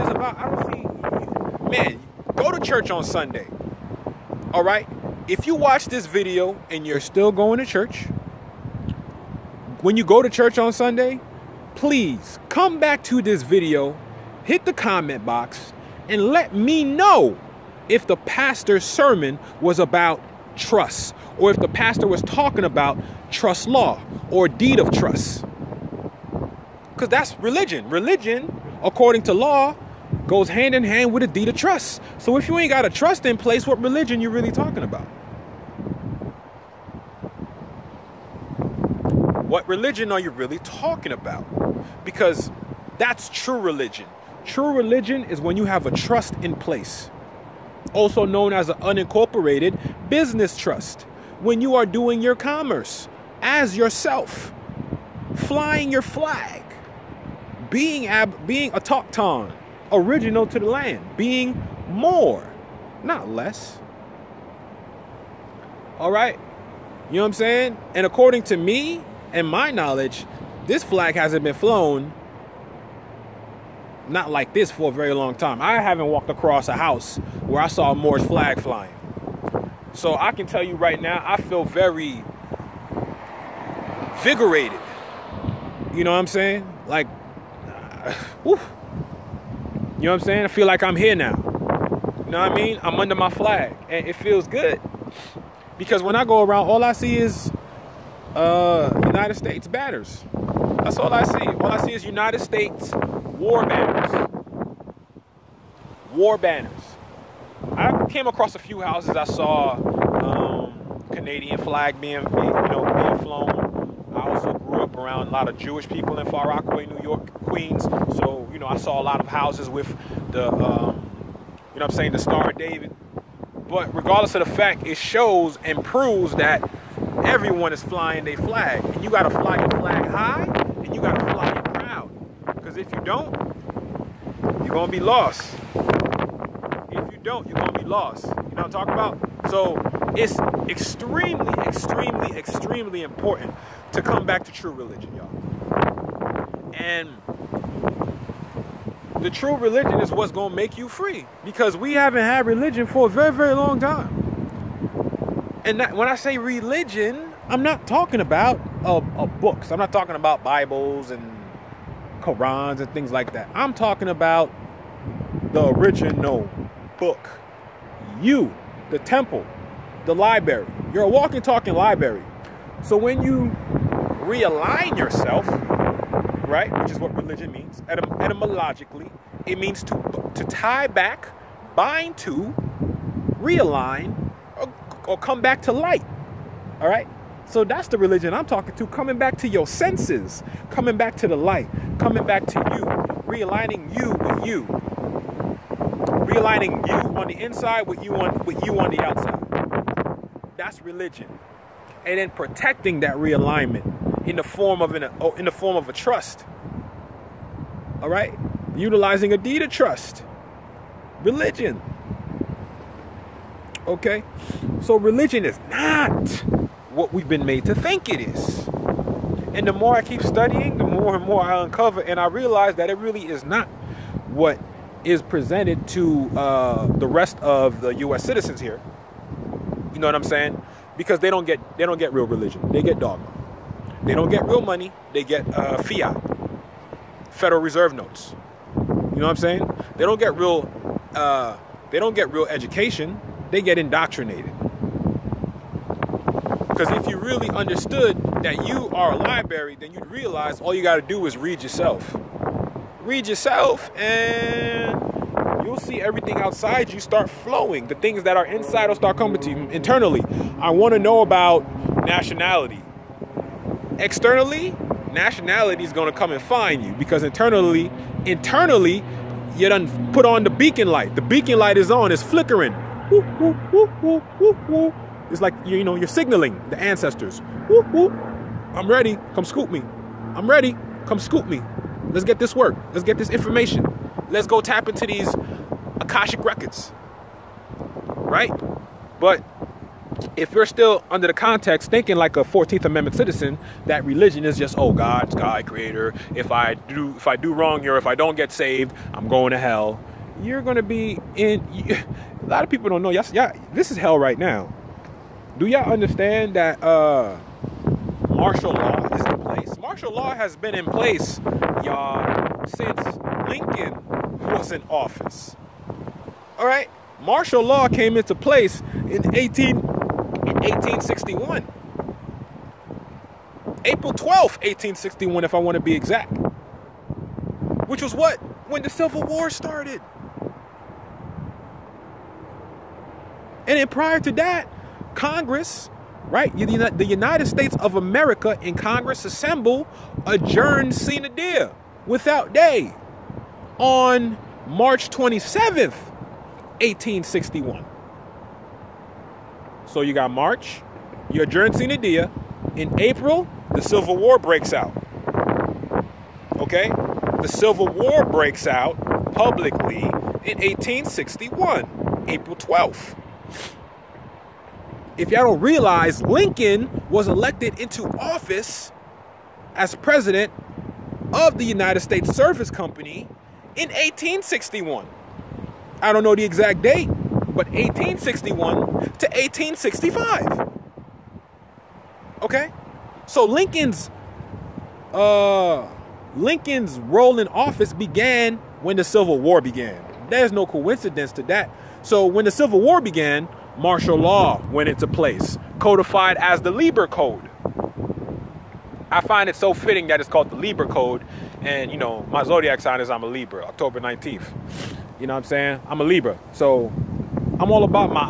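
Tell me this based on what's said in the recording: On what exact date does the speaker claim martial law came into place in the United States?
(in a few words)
April 12, 1861.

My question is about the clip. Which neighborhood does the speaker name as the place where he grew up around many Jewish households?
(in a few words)
Far Rockaway.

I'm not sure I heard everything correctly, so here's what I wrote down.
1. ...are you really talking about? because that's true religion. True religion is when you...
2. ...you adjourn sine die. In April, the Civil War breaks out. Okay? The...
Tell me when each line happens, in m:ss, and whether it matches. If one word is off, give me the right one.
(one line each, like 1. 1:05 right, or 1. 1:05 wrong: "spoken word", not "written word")
1. 0:40 right
2. 5:51 right.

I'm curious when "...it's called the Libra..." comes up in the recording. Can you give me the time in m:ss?
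6:40.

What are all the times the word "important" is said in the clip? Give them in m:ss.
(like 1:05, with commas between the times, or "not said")
2:23.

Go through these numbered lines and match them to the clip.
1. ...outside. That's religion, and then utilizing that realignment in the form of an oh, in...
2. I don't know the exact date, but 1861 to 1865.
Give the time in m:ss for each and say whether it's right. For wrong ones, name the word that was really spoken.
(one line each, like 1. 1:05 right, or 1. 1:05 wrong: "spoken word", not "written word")
1. 3:19 wrong: "protecting", not "utilizing"
2. 6:16 right.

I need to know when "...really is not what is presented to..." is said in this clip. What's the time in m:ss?
3:42.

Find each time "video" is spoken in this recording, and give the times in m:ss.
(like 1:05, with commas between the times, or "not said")
0:06, 0:13.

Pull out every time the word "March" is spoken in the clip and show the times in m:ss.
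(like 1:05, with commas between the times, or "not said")
5:44, 5:50.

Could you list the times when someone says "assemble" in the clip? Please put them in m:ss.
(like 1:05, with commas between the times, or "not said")
5:39.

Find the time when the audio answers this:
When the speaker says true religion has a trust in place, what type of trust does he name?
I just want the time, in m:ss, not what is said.
0:48.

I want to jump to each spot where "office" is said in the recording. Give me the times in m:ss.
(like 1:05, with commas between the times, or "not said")
5:14, 6:08, 6:27.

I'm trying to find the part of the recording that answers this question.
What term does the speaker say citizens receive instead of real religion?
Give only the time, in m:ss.
3:52.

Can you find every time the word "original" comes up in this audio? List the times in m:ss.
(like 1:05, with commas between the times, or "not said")
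0:59, 2:45.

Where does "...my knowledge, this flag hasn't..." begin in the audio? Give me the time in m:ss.
1:09.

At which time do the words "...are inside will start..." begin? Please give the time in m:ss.
4:18.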